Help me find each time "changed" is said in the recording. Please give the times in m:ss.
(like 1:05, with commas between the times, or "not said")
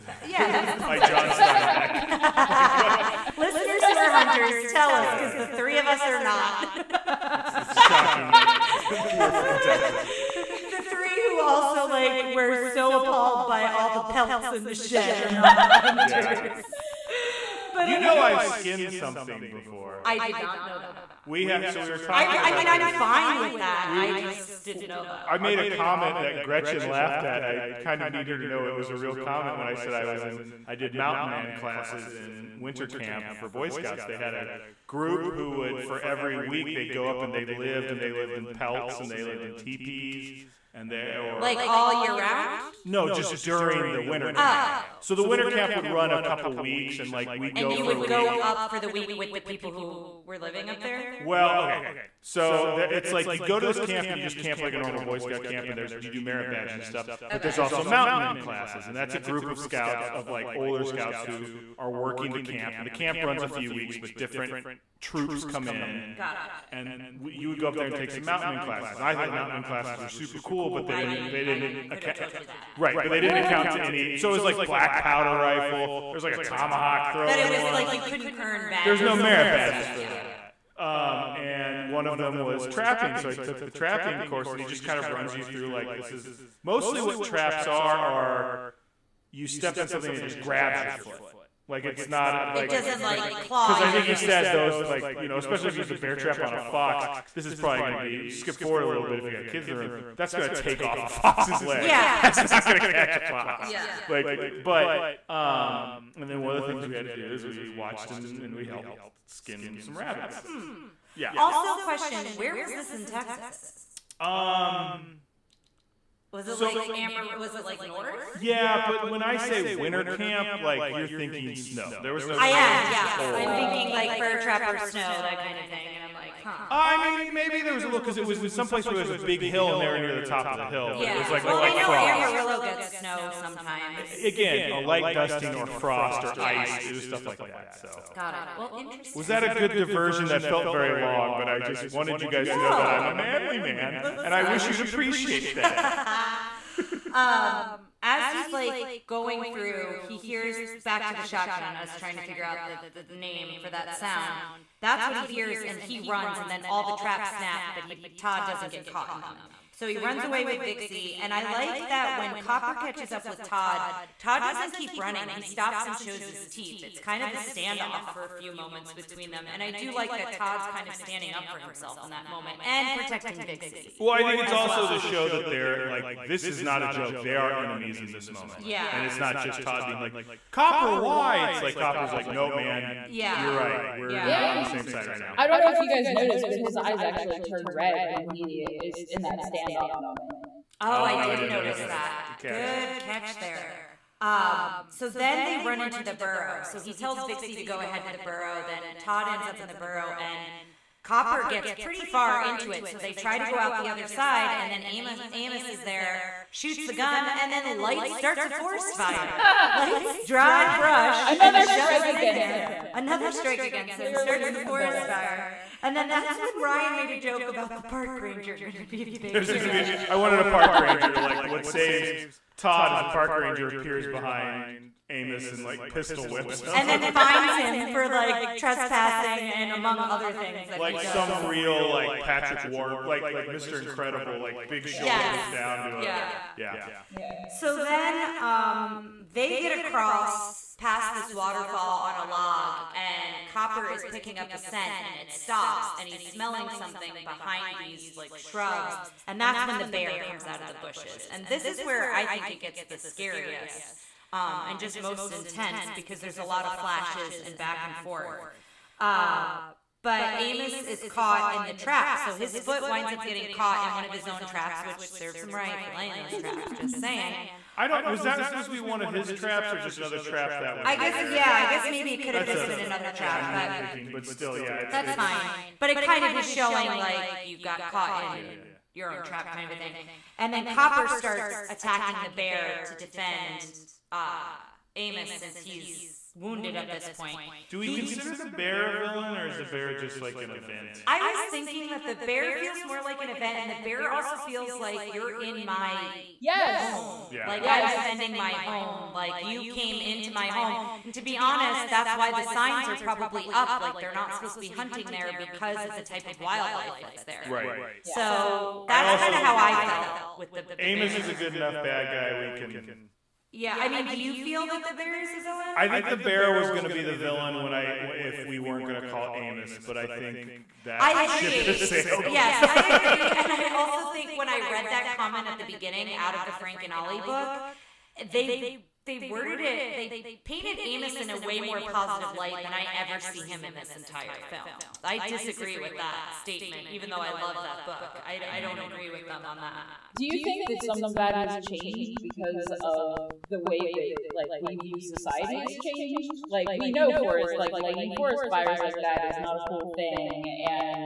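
5:41, 5:45.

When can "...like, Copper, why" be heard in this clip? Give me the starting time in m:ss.
2:59.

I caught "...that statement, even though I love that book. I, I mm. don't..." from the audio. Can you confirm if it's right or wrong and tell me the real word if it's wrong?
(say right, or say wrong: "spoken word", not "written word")
right.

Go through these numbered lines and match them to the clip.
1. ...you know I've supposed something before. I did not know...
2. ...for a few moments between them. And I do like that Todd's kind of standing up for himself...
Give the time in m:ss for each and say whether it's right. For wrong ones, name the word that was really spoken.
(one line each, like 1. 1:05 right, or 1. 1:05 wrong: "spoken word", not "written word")
1. 0:17 wrong: "skinned", not "supposed"
2. 2:48 right.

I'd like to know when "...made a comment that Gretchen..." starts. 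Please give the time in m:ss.
0:25.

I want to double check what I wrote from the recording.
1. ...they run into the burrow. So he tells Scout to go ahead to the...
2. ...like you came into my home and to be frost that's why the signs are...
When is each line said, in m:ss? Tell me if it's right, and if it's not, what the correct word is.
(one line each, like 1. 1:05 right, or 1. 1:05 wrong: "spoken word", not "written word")
1. 3:15 wrong: "Vixey", not "Scout"
2. 4:59 wrong: "honest", not "frost".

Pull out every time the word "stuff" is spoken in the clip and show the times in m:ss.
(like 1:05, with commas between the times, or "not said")
0:56, 1:19, 2:17.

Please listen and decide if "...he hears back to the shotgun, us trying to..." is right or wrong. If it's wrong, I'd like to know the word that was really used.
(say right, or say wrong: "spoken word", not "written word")
right.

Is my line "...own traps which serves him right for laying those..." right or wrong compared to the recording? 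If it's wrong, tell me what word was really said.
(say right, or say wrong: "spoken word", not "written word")
right.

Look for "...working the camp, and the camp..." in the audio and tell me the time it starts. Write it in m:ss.
1:01.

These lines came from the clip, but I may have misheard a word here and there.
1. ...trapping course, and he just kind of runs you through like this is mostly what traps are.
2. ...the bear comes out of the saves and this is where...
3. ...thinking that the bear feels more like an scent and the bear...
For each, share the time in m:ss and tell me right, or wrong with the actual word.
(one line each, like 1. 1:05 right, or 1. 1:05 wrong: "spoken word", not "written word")
1. 1:23 right
2. 4:09 wrong: "bushes", not "saves"
3. 4:51 wrong: "event", not "scent".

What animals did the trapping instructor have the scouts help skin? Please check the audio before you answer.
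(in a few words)
rabbits.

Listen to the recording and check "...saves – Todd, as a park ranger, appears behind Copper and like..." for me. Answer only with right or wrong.
wrong.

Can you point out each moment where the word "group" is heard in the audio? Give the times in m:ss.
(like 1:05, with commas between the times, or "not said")
0:34, 0:59.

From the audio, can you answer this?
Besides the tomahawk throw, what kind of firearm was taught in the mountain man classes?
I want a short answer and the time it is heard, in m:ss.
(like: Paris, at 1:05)
black powder rifle, at 1:14.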